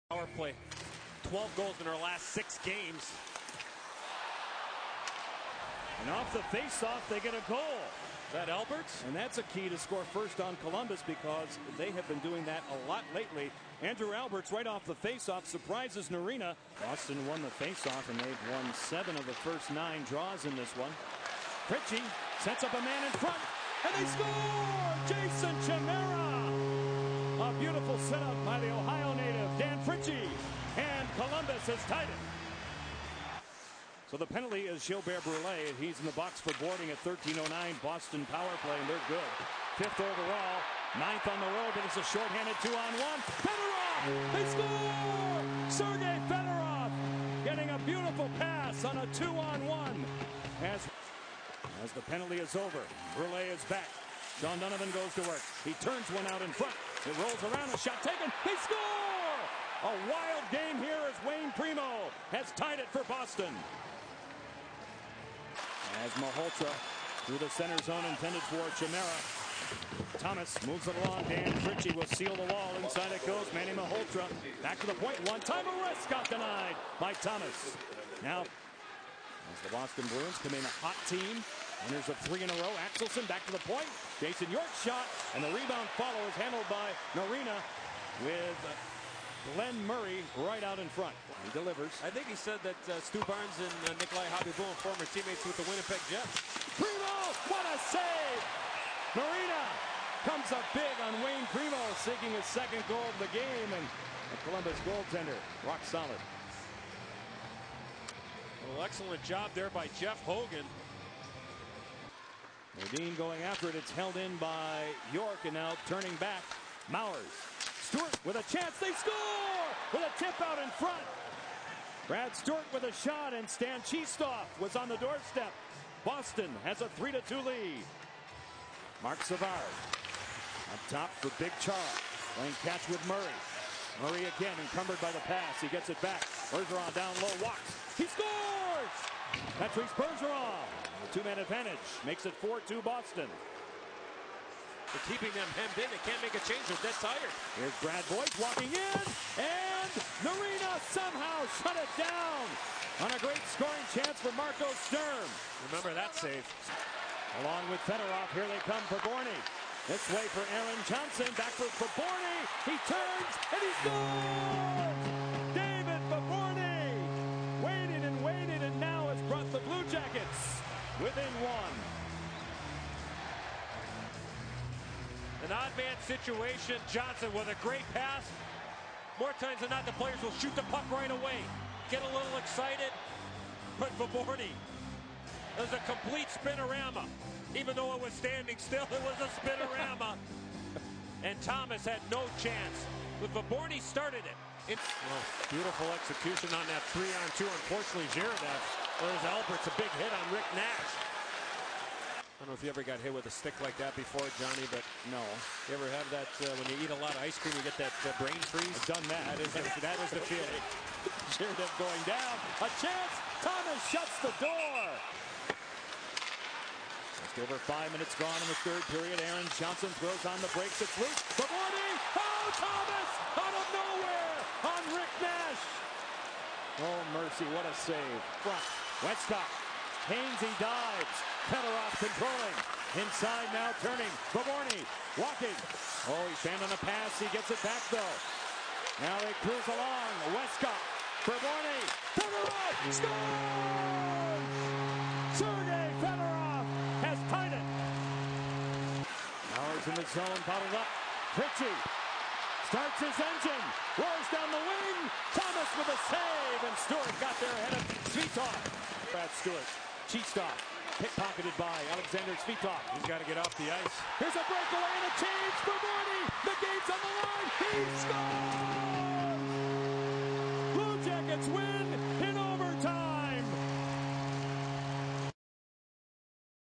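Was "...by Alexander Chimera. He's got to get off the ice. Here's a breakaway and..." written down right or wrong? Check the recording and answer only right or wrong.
wrong.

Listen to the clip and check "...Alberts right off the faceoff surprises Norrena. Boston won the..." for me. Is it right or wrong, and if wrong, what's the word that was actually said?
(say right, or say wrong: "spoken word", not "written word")
right.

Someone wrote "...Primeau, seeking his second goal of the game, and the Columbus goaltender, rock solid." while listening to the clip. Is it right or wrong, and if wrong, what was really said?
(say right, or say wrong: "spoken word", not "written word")
right.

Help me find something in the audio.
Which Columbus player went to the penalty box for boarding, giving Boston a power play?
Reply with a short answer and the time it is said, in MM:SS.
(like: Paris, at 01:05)
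Gilbert Brule, at 00:34.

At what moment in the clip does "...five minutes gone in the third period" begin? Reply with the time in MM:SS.
03:37.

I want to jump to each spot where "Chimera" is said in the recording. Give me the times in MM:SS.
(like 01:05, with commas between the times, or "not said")
00:25, 01:08.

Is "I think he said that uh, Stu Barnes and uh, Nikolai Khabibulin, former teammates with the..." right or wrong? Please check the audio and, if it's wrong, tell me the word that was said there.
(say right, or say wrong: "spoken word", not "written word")
right.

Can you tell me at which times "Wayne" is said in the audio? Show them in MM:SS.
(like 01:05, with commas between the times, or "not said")
01:01, 01:41.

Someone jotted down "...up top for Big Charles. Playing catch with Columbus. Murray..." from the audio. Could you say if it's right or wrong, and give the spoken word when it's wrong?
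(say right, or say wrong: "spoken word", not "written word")
wrong: "Murray", not "Columbus".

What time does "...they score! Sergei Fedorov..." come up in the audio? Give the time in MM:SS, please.
00:44.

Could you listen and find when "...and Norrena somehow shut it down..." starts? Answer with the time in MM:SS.
02:29.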